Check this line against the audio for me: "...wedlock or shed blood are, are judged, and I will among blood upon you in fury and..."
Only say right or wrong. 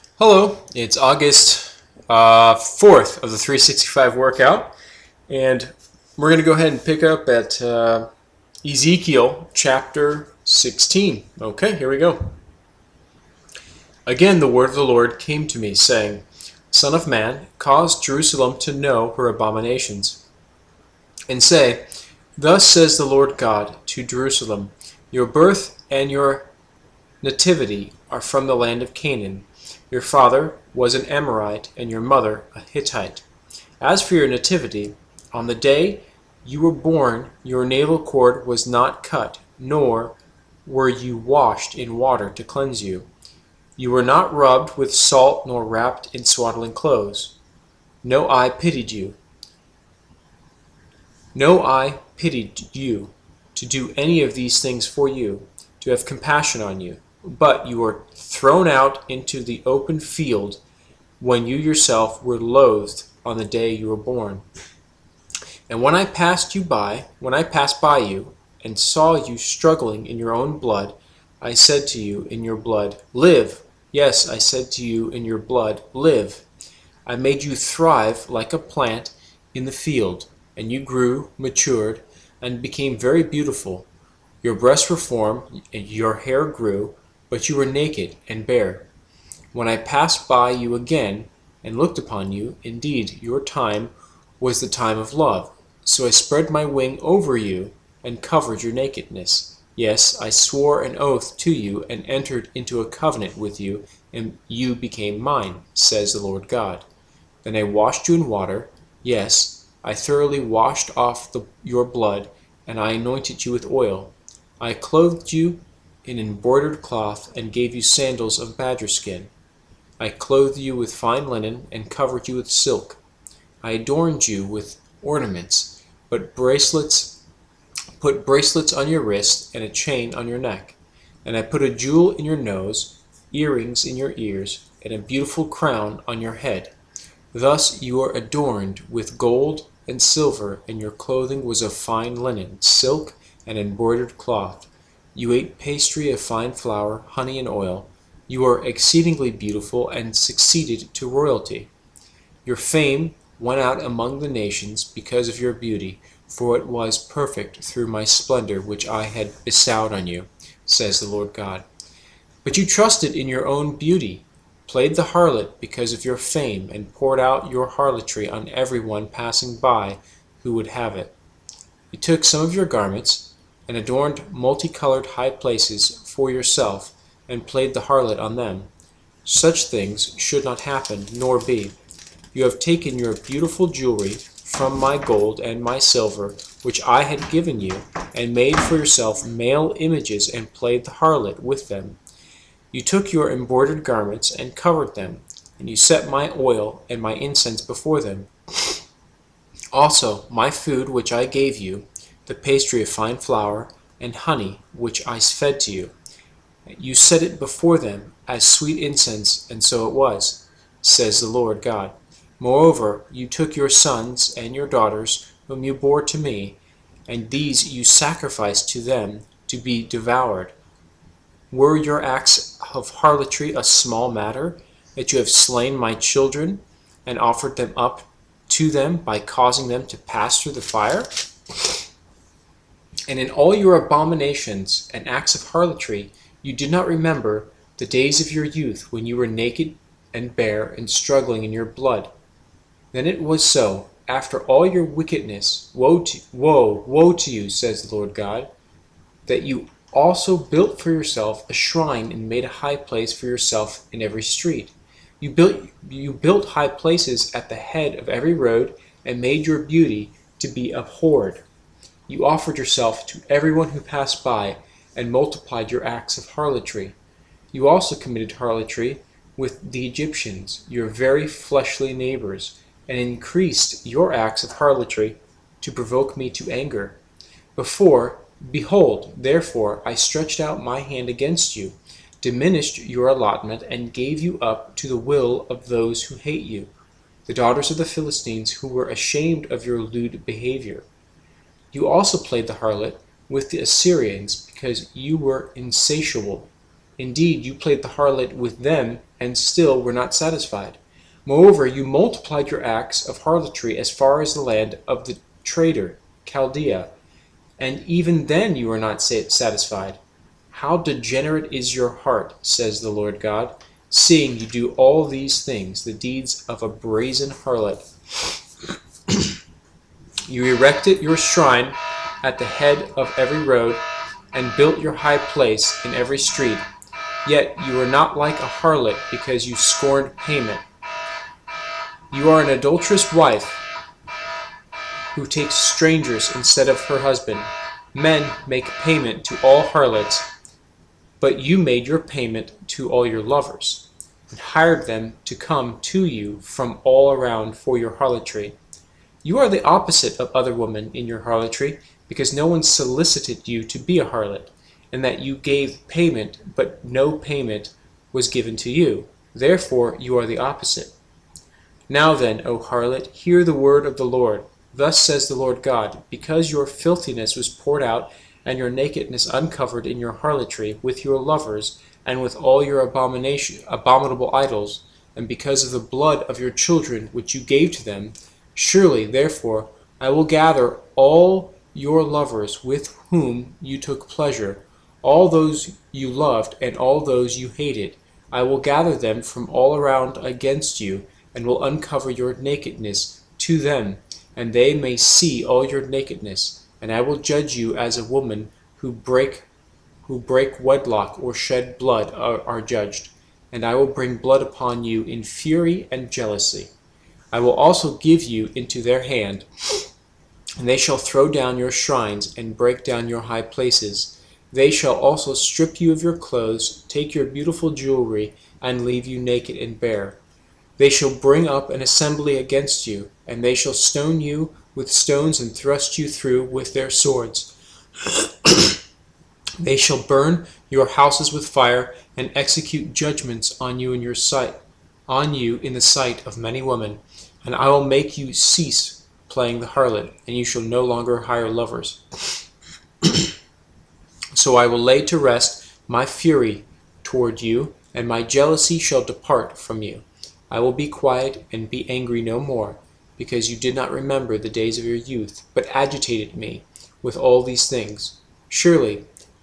wrong.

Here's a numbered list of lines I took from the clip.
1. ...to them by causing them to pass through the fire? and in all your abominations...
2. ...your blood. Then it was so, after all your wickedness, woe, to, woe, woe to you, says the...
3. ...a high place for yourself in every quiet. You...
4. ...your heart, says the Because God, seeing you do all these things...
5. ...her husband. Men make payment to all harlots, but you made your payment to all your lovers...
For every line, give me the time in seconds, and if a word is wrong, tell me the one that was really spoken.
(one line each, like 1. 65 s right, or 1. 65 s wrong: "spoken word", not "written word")
1. 228 s right
2. 241 s right
3. 252 s wrong: "street", not "quiet"
4. 311 s wrong: "Lord", not "Because"
5. 336 s right.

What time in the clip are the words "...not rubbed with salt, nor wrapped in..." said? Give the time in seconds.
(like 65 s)
44 s.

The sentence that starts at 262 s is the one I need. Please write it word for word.
You offered yourself to everyone who passed by and multiplied your acts of harlotry.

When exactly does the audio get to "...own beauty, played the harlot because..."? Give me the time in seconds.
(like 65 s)
163 s.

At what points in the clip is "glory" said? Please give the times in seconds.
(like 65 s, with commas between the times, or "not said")
not said.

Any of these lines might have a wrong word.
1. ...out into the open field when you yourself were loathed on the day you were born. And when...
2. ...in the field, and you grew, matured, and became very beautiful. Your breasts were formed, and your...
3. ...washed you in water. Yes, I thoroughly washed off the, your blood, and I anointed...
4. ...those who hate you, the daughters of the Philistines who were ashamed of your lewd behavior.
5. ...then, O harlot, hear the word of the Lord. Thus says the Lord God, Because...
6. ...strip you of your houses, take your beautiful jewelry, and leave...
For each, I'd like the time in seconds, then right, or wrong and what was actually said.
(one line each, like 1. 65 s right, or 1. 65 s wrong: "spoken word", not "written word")
1. 58 s right
2. 79 s right
3. 107 s right
4. 285 s right
5. 362 s right
6. 415 s wrong: "clothes", not "houses".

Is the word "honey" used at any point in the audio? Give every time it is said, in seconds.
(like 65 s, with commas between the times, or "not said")
147 s, 204 s.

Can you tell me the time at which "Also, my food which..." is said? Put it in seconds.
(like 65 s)
199 s.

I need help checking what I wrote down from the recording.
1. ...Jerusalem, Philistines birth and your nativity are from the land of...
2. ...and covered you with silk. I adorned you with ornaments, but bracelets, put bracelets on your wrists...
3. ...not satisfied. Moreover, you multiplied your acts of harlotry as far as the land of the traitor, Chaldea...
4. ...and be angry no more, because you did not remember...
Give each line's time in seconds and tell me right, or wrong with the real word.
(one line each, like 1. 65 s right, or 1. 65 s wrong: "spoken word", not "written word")
1. 24 s wrong: "Your", not "Philistines"
2. 121 s right
3. 299 s right
4. 451 s right.